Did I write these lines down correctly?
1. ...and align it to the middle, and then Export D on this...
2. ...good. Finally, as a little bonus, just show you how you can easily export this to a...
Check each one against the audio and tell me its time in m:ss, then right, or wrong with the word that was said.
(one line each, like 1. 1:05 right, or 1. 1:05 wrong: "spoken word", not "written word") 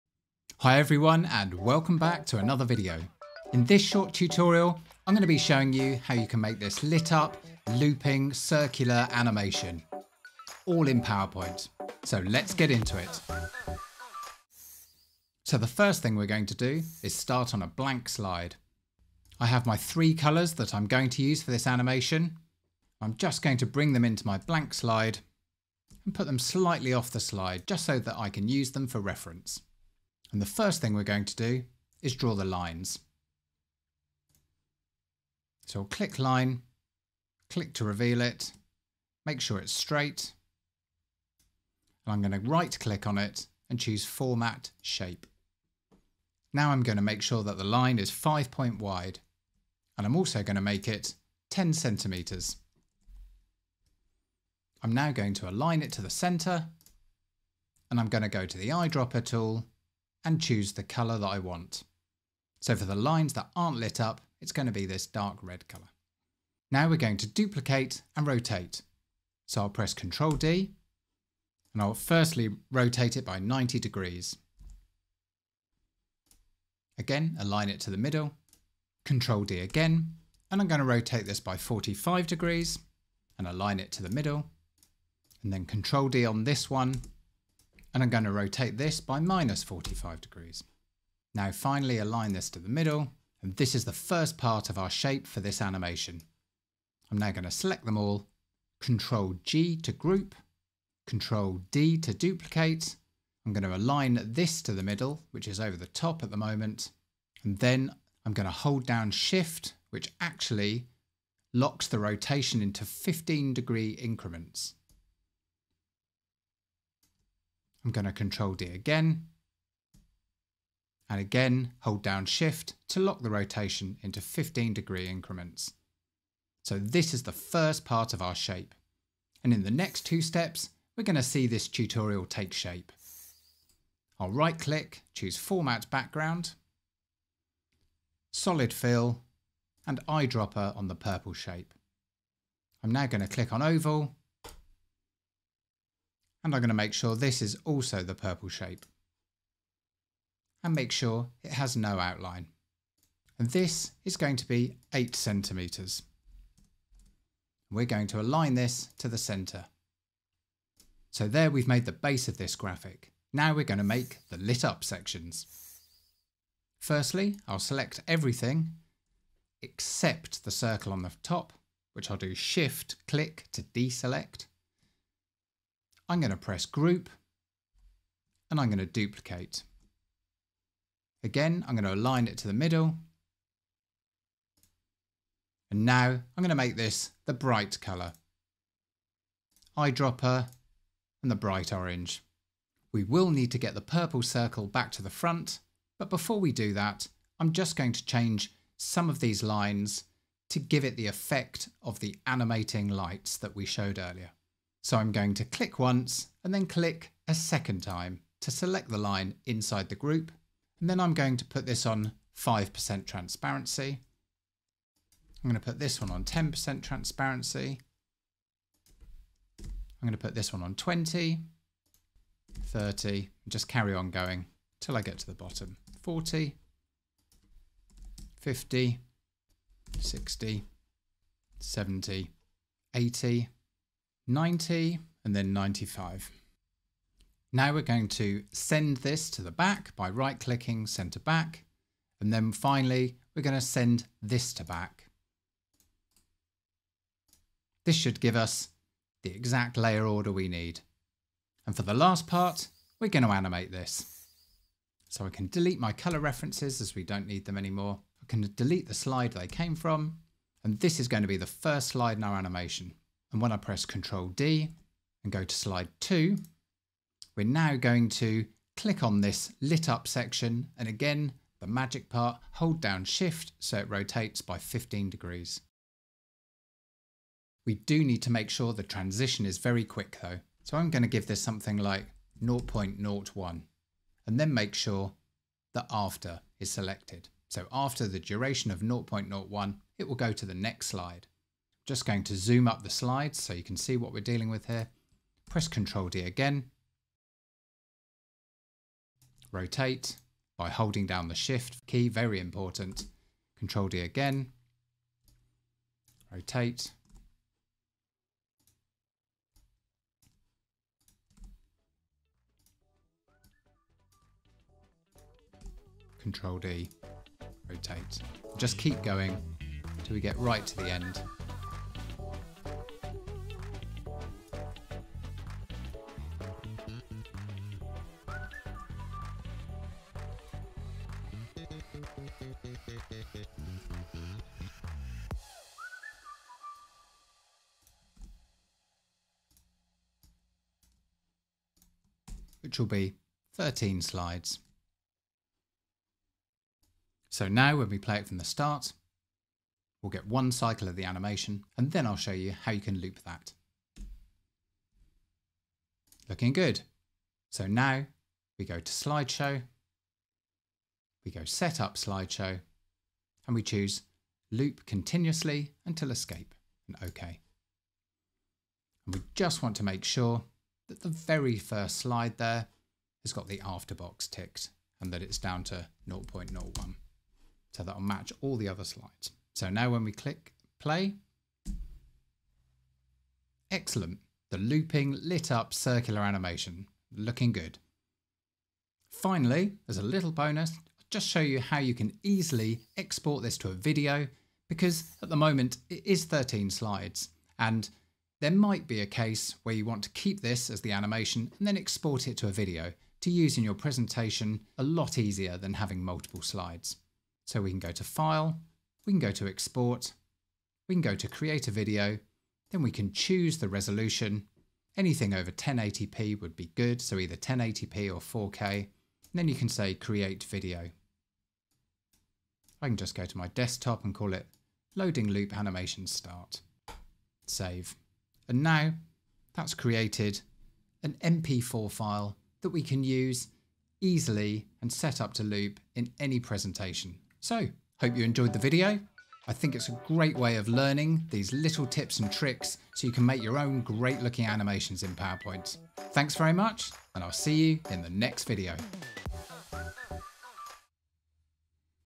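1. 1:23 wrong: "Ctrl", not "Export"
2. 6:27 right.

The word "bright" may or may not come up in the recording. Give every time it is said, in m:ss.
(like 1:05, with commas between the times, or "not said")
3:07, 3:11.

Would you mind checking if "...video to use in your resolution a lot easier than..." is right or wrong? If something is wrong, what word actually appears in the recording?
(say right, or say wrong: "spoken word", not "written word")
wrong: "presentation", not "resolution".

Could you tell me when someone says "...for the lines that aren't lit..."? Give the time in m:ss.
1:02.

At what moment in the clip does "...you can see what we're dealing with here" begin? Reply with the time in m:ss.
4:53.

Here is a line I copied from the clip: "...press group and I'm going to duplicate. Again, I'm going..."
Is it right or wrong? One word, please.
right.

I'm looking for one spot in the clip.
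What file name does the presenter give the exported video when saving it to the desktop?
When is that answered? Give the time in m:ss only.
7:04.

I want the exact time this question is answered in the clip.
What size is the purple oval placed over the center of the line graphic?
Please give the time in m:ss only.
2:34.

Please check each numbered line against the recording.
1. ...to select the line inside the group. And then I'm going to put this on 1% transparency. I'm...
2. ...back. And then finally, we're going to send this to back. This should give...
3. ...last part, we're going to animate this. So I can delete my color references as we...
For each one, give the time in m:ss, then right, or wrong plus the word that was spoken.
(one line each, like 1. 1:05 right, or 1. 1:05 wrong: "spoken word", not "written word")
1. 3:28 wrong: "5", not "1"
2. 4:01 right
3. 4:11 right.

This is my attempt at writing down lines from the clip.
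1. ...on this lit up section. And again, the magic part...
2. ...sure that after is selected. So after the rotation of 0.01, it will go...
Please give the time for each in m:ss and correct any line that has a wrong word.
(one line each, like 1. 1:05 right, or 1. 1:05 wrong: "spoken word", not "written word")
1. 4:29 right
2. 4:44 wrong: "duration", not "rotation".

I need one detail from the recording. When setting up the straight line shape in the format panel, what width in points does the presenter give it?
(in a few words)
5 point.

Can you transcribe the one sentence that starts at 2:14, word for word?
I'll right click, choose format background, solid fill and eyedropper on the purple shape.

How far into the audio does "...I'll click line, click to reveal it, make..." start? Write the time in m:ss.
0:35.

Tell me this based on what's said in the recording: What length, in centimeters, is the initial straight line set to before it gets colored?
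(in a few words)
10 centimeters.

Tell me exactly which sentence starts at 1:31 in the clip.
Now finally align this to the middle, and this is the first part of our shape for this animation.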